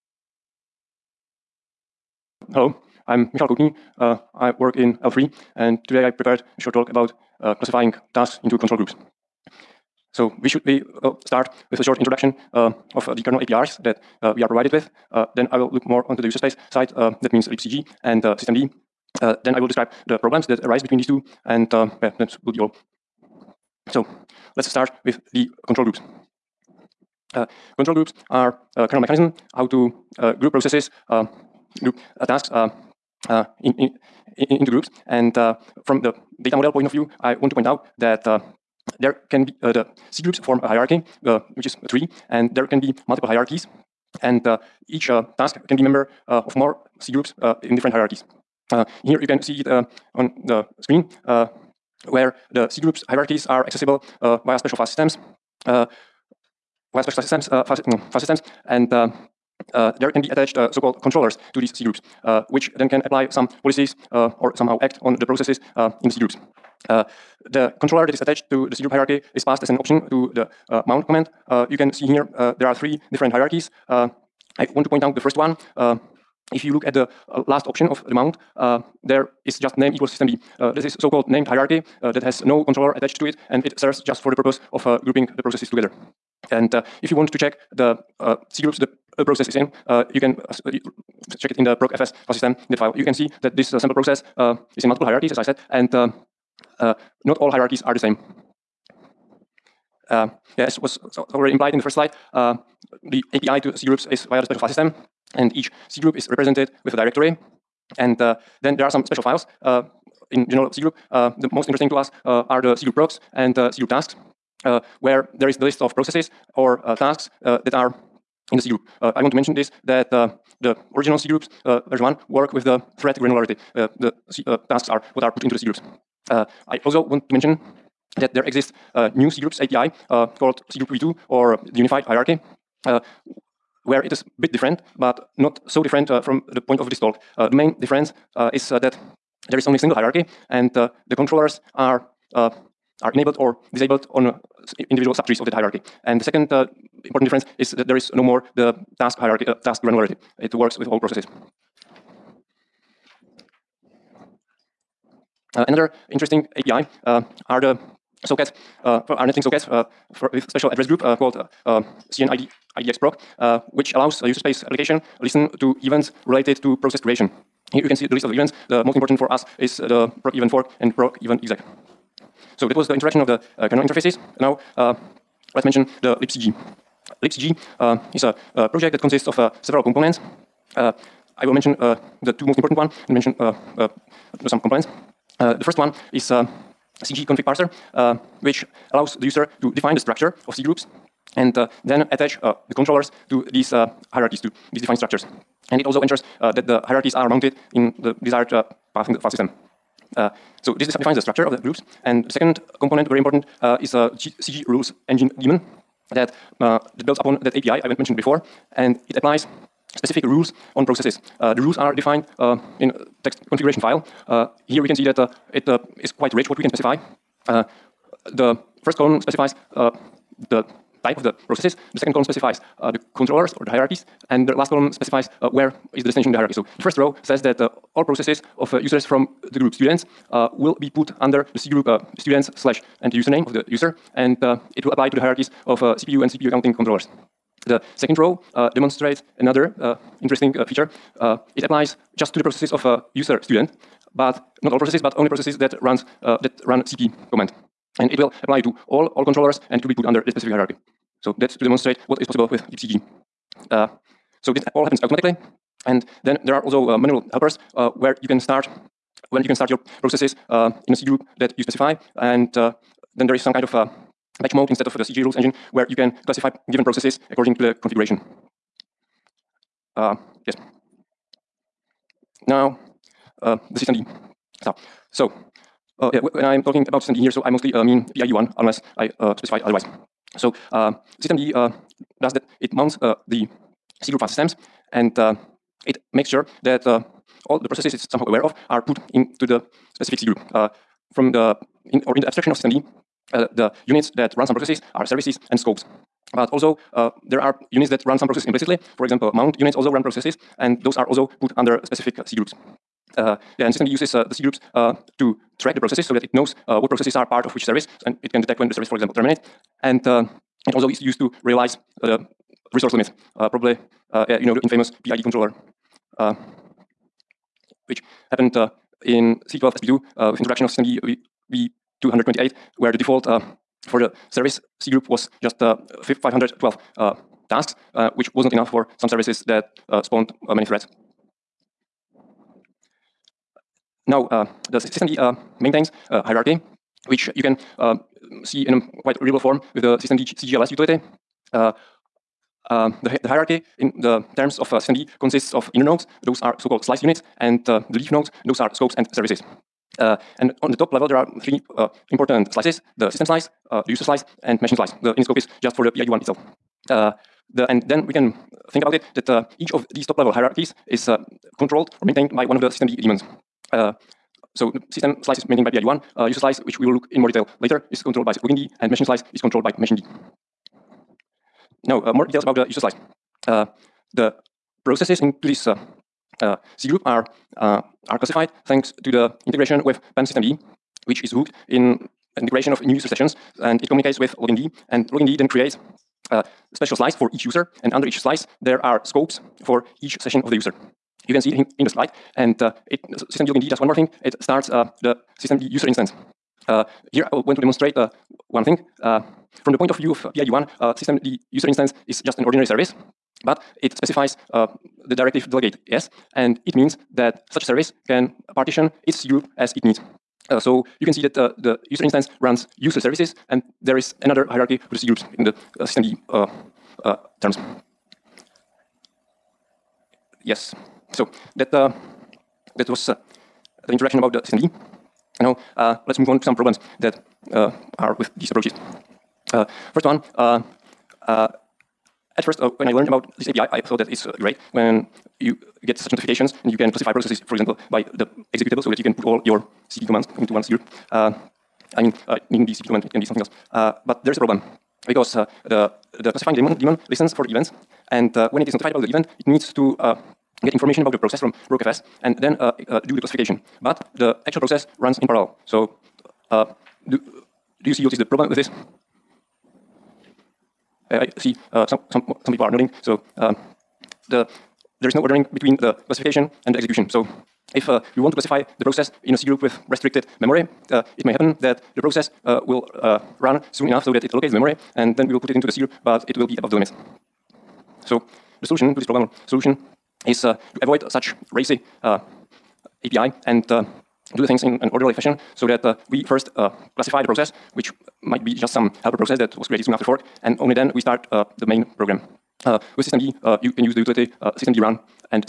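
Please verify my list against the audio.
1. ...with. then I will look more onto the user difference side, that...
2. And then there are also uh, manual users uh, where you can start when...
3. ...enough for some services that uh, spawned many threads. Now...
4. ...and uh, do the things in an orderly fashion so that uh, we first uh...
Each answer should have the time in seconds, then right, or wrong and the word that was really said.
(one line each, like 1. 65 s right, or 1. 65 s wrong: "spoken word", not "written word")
1. 14 s wrong: "space", not "difference"
2. 255 s wrong: "helpers", not "users"
3. 328 s right
4. 483 s right.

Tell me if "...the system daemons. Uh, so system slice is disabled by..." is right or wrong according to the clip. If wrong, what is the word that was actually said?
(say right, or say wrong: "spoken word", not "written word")
wrong: "maintained", not "disabled".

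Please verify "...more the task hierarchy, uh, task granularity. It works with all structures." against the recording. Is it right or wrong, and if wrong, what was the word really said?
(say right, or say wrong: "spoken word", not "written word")
wrong: "processes", not "structures".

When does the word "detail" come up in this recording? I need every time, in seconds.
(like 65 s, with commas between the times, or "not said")
367 s, 372 s.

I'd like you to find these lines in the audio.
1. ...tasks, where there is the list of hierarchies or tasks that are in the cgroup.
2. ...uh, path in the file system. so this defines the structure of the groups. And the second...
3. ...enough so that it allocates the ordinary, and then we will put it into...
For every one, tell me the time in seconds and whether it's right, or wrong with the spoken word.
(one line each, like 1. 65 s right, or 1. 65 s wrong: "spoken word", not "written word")
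1. 113 s wrong: "processes", not "hierarchies"
2. 198 s right
3. 473 s wrong: "memory", not "ordinary".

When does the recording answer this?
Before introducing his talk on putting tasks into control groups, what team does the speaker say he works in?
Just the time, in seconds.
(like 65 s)
5 s.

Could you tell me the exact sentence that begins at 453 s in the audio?
But the actual process runs in parallel.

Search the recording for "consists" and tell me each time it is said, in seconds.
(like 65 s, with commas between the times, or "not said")
179 s, 345 s.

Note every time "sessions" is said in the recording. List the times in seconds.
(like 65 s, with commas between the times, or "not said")
383 s, 390 s.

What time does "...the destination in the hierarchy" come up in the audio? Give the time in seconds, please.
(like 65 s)
226 s.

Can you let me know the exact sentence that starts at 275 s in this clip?
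So, uh, yeah, when I'm talking about systemd here, so I mostly uh, mean PID1, unless I uh, specified otherwise.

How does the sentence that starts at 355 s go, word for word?
The scope is just for the PID one itself.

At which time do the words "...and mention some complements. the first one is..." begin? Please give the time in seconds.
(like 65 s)
183 s.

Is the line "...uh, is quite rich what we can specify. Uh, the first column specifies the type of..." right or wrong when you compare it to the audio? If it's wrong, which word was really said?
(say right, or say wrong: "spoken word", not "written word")
right.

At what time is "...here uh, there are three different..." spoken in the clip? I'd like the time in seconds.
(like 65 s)
72 s.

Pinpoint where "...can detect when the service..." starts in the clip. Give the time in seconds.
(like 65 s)
308 s.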